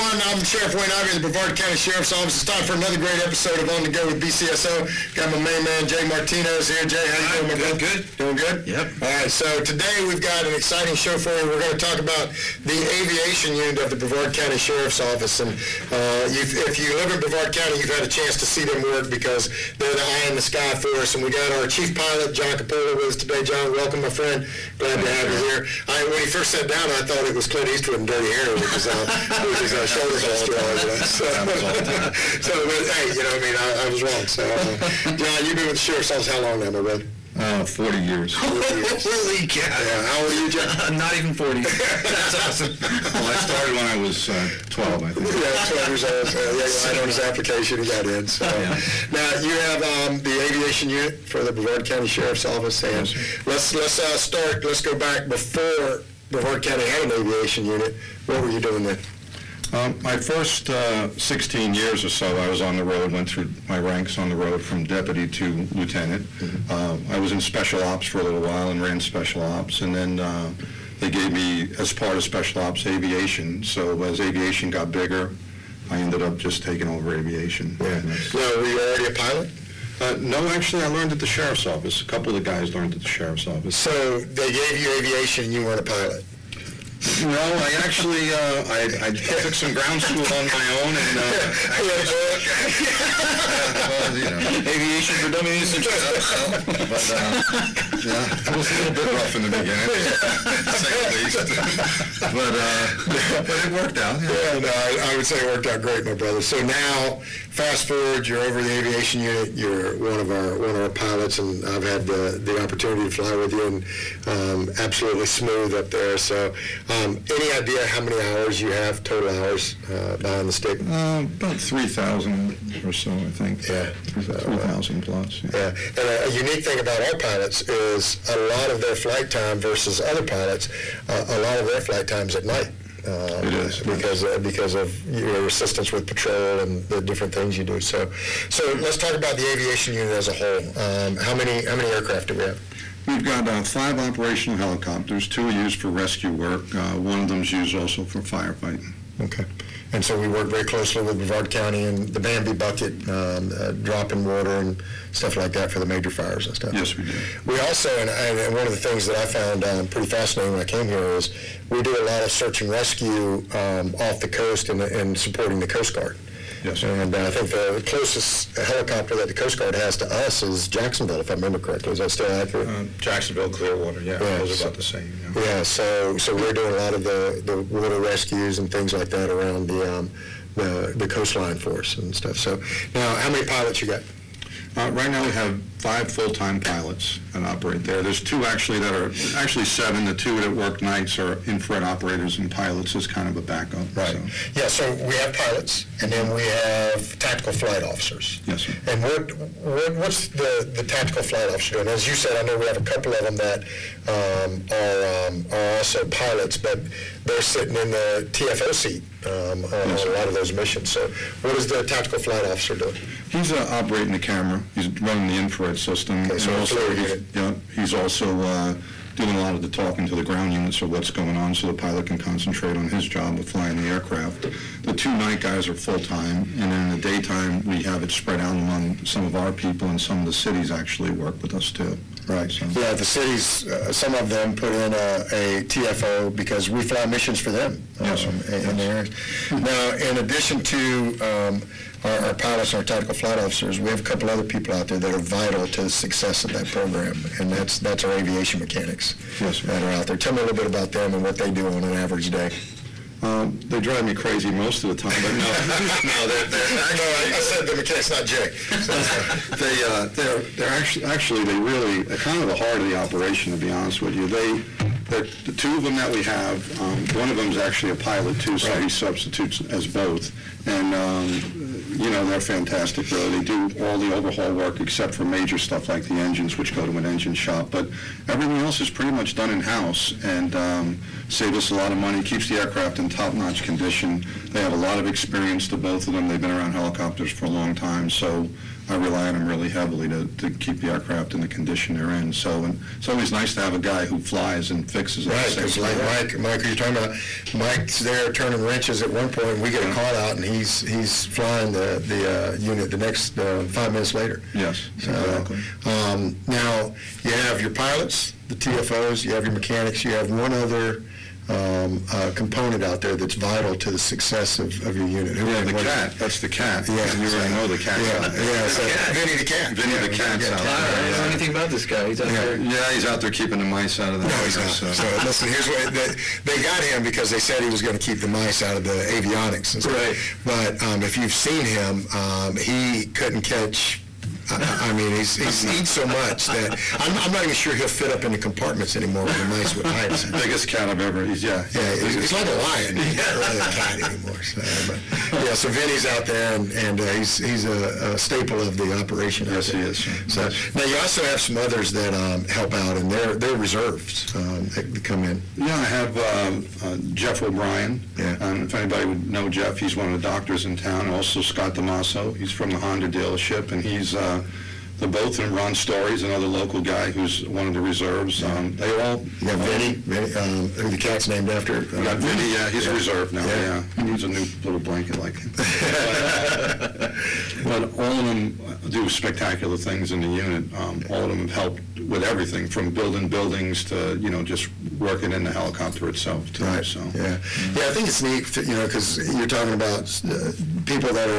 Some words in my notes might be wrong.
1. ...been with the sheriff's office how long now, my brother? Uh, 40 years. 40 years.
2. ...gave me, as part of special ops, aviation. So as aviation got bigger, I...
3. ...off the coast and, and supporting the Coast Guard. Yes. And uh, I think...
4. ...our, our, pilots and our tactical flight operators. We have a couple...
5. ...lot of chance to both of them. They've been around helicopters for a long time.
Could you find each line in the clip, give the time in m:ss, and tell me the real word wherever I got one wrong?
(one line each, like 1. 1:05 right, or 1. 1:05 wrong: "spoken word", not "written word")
1. 0:35 right
2. 1:11 right
3. 2:43 right
4. 4:02 wrong: "officers", not "operators"
5. 4:44 wrong: "experience", not "chance".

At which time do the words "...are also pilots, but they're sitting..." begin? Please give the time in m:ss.
3:25.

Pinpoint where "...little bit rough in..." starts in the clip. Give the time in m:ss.
1:38.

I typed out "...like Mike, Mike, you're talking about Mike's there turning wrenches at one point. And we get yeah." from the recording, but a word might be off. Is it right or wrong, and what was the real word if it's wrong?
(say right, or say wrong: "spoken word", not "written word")
right.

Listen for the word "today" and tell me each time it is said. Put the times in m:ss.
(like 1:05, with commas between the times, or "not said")
0:09, 0:23.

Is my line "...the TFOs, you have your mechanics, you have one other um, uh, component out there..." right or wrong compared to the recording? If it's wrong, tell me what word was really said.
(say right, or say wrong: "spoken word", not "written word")
right.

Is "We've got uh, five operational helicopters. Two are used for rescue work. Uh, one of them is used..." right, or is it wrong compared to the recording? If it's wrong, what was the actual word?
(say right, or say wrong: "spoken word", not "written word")
right.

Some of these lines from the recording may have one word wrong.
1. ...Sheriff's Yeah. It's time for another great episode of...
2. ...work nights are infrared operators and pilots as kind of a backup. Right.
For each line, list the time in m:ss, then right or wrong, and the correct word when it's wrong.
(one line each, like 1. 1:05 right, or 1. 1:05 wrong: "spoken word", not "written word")
1. 0:01 wrong: "Office", not "Yeah"
2. 3:10 right.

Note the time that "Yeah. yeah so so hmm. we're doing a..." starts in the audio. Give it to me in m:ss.
2:55.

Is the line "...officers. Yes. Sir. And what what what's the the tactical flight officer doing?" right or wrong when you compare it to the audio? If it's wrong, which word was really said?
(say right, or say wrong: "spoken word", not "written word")
right.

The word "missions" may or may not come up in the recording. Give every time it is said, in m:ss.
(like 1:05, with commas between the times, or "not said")
3:30, 3:57.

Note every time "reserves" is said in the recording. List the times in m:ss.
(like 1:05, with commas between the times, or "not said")
5:53, 6:07, 6:12.